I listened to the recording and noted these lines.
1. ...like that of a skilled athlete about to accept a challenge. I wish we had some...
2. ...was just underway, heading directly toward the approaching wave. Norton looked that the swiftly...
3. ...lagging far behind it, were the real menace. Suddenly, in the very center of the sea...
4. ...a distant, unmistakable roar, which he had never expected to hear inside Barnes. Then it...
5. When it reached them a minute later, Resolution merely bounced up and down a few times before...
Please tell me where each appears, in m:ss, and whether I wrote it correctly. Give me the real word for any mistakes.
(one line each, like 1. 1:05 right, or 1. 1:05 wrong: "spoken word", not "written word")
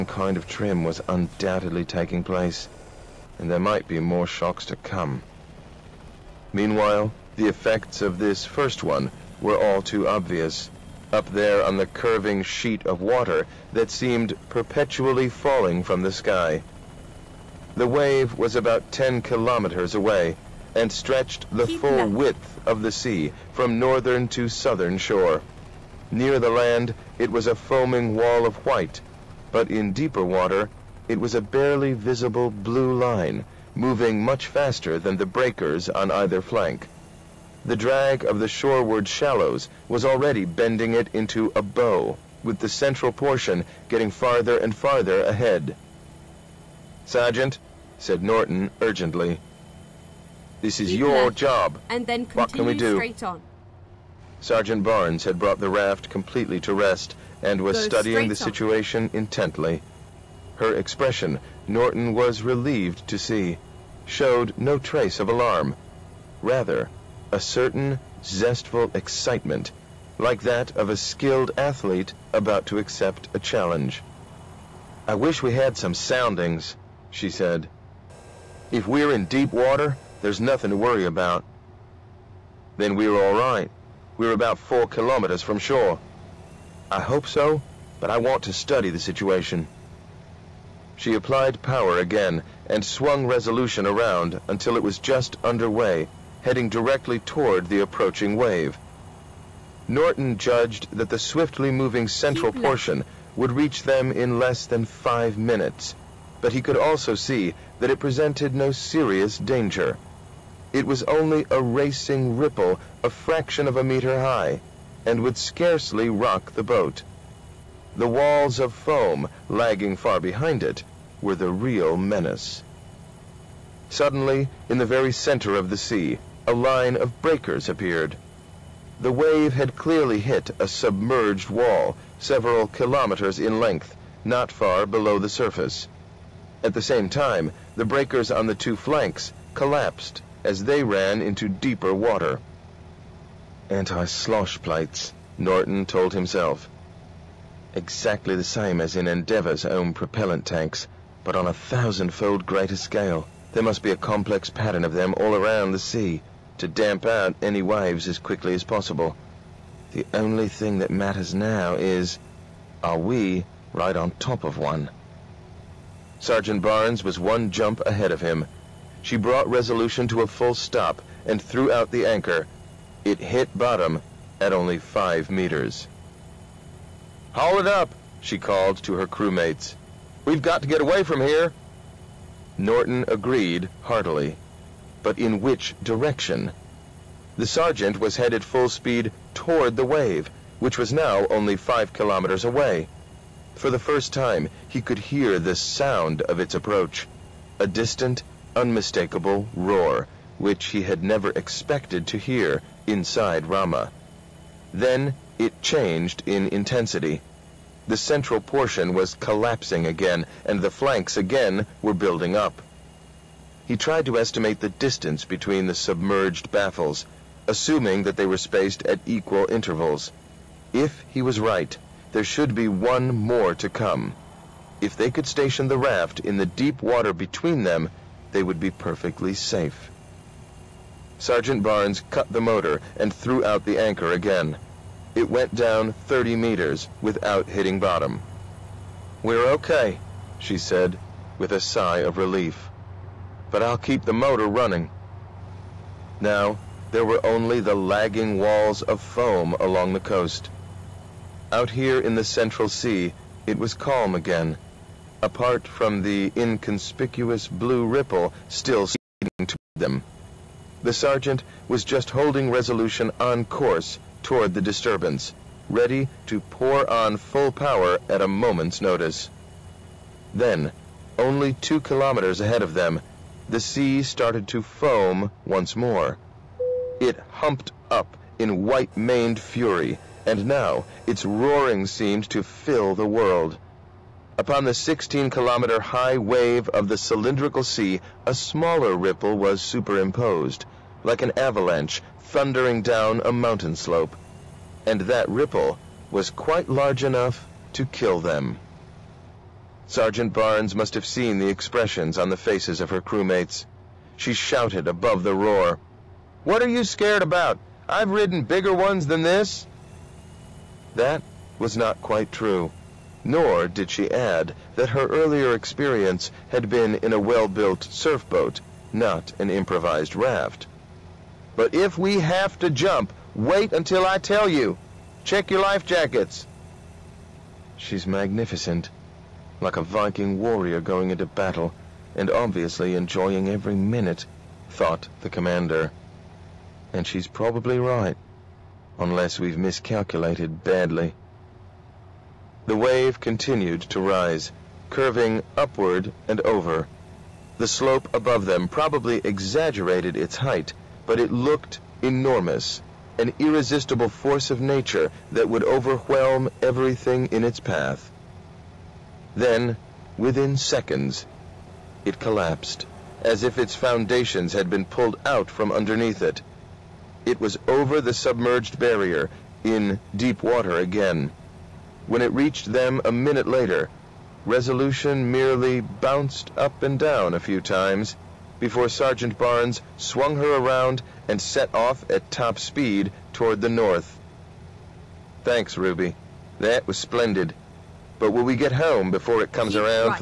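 1. 1:10 right
2. 1:34 wrong: "judged", not "looked"
3. 1:59 right
4. 3:17 wrong: "Rama", not "Barnes"
5. 6:12 right.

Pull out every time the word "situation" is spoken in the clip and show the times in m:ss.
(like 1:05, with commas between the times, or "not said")
0:58, 1:28.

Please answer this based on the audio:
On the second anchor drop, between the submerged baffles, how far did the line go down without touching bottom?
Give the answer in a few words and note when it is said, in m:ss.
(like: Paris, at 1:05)
30 meters, at 3:56.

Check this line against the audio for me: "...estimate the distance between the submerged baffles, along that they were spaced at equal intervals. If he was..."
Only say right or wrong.
wrong.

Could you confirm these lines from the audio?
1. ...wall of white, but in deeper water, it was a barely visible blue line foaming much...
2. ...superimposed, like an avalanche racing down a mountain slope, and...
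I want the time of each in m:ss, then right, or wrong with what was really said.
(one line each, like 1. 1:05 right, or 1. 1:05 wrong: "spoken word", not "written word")
1. 0:28 wrong: "moving", not "foaming"
2. 4:49 wrong: "thundering", not "racing".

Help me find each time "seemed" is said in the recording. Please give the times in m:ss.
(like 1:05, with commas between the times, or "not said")
0:13, 4:41.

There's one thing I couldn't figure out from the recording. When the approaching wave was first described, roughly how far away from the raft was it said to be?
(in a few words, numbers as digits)
10 kilometers.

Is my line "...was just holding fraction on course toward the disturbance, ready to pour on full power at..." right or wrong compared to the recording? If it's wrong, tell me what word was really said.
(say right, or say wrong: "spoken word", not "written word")
wrong: "resolution", not "fraction".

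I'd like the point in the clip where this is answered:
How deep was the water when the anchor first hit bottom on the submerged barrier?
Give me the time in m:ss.
2:54.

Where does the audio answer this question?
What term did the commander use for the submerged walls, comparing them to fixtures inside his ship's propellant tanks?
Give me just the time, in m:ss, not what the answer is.
2:23.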